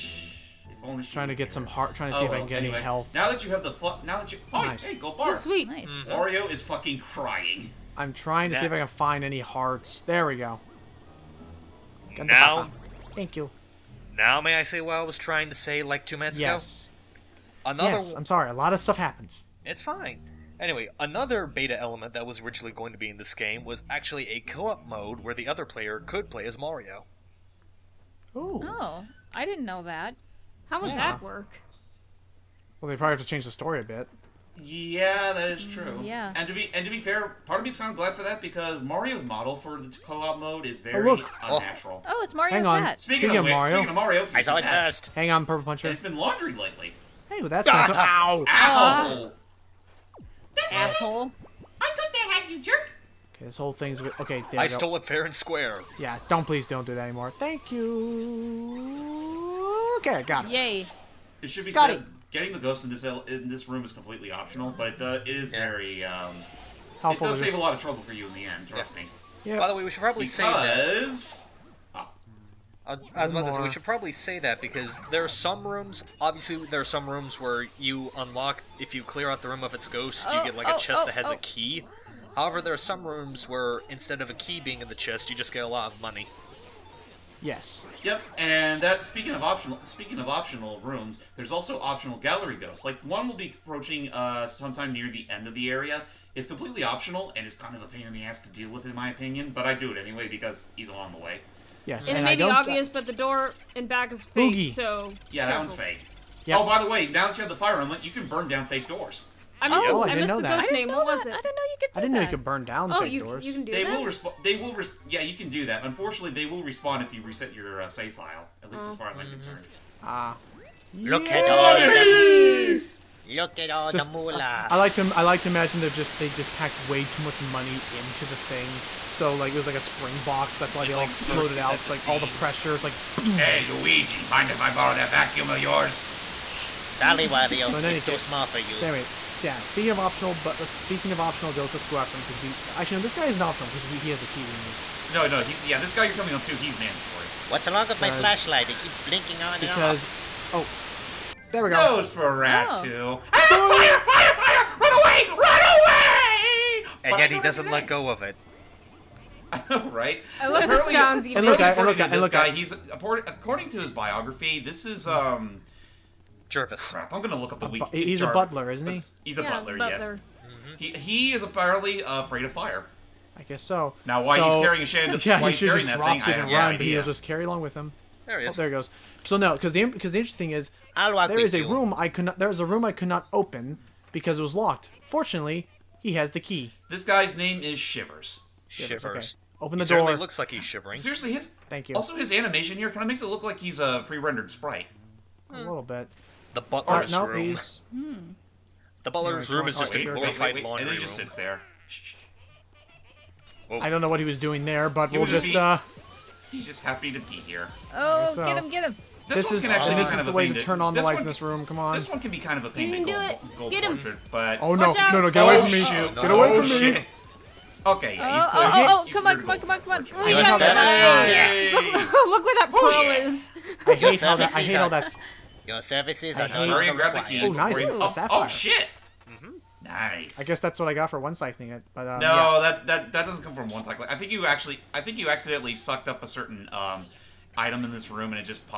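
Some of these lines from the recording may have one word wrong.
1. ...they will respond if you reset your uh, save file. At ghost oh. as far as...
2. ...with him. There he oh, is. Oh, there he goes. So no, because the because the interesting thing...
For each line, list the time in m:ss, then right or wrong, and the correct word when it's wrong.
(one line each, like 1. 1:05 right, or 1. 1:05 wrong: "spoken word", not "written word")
1. 1:56 wrong: "least", not "ghost"
2. 2:57 right.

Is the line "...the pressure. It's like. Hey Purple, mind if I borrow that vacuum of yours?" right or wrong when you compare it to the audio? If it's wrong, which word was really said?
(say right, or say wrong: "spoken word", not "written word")
wrong: "Luigi", not "Purple".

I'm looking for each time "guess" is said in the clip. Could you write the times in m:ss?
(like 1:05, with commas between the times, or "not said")
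2:53, 3:50.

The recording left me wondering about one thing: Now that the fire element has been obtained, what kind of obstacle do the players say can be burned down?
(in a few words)
Fake doors.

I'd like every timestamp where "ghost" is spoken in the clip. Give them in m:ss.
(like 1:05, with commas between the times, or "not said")
1:02, 1:19, 1:32, 1:50, 2:21.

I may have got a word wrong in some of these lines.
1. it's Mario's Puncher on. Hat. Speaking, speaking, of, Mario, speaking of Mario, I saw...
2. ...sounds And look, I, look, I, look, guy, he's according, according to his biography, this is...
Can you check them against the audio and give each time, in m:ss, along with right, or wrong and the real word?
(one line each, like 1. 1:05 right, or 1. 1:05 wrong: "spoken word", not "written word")
1. 0:42 wrong: "Hang", not "Puncher"
2. 2:40 right.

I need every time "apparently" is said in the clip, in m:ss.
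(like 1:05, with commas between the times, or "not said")
2:40, 2:51.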